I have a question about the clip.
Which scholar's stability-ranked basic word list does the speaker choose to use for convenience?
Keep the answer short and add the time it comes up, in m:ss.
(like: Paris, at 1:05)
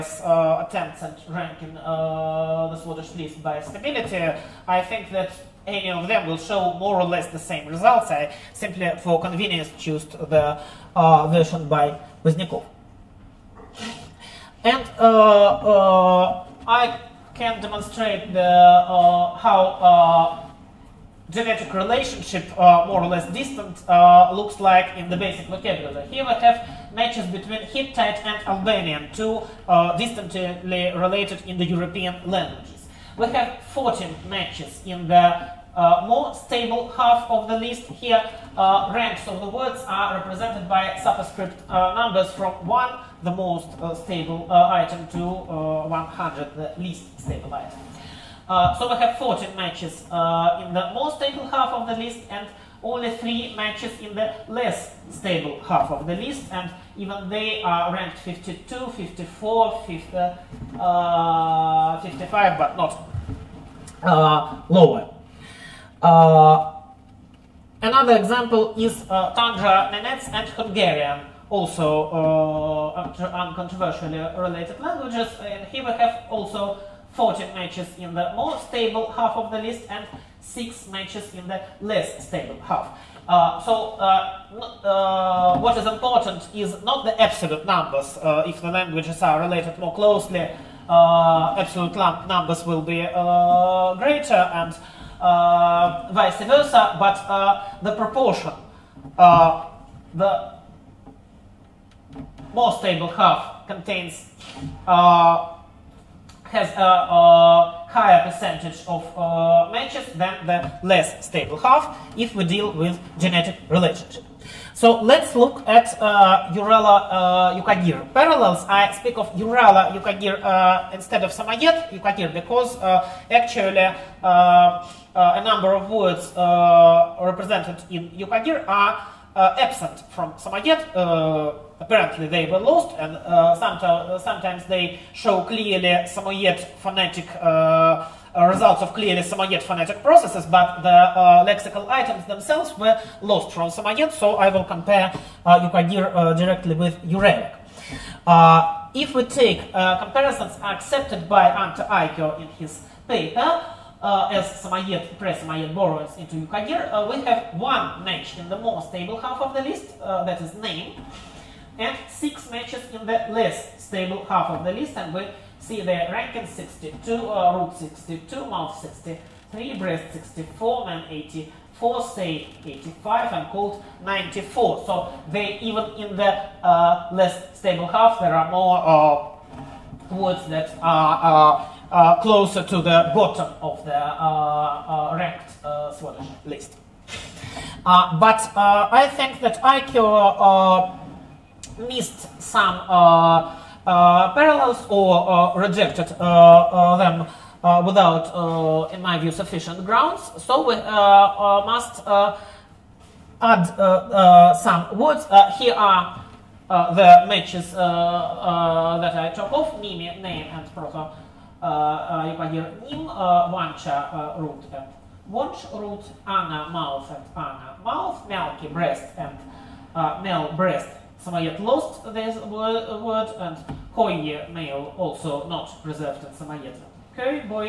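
Pozdniakov, at 0:12.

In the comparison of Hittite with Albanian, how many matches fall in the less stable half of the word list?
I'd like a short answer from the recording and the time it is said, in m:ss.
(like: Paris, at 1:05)
3, at 0:53.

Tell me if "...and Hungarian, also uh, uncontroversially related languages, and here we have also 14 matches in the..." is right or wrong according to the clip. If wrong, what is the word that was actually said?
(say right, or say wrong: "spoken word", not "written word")
right.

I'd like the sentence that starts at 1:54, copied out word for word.
So let's look at uh, Urala uh, Yukagir parallels.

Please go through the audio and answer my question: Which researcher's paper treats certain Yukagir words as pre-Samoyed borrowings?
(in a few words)
Ante Aikio.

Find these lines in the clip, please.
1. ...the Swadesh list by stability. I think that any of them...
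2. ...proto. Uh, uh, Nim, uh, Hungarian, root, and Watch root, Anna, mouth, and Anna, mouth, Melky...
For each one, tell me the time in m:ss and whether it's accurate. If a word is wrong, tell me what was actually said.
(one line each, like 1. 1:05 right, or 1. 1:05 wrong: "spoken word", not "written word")
1. 0:01 right
2. 3:30 wrong: "Mancha", not "Hungarian".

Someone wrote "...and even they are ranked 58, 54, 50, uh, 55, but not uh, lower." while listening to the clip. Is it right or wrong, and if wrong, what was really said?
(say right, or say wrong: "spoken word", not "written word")
wrong: "52", not "58".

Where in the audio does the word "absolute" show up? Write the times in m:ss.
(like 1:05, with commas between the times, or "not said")
1:27, 1:31.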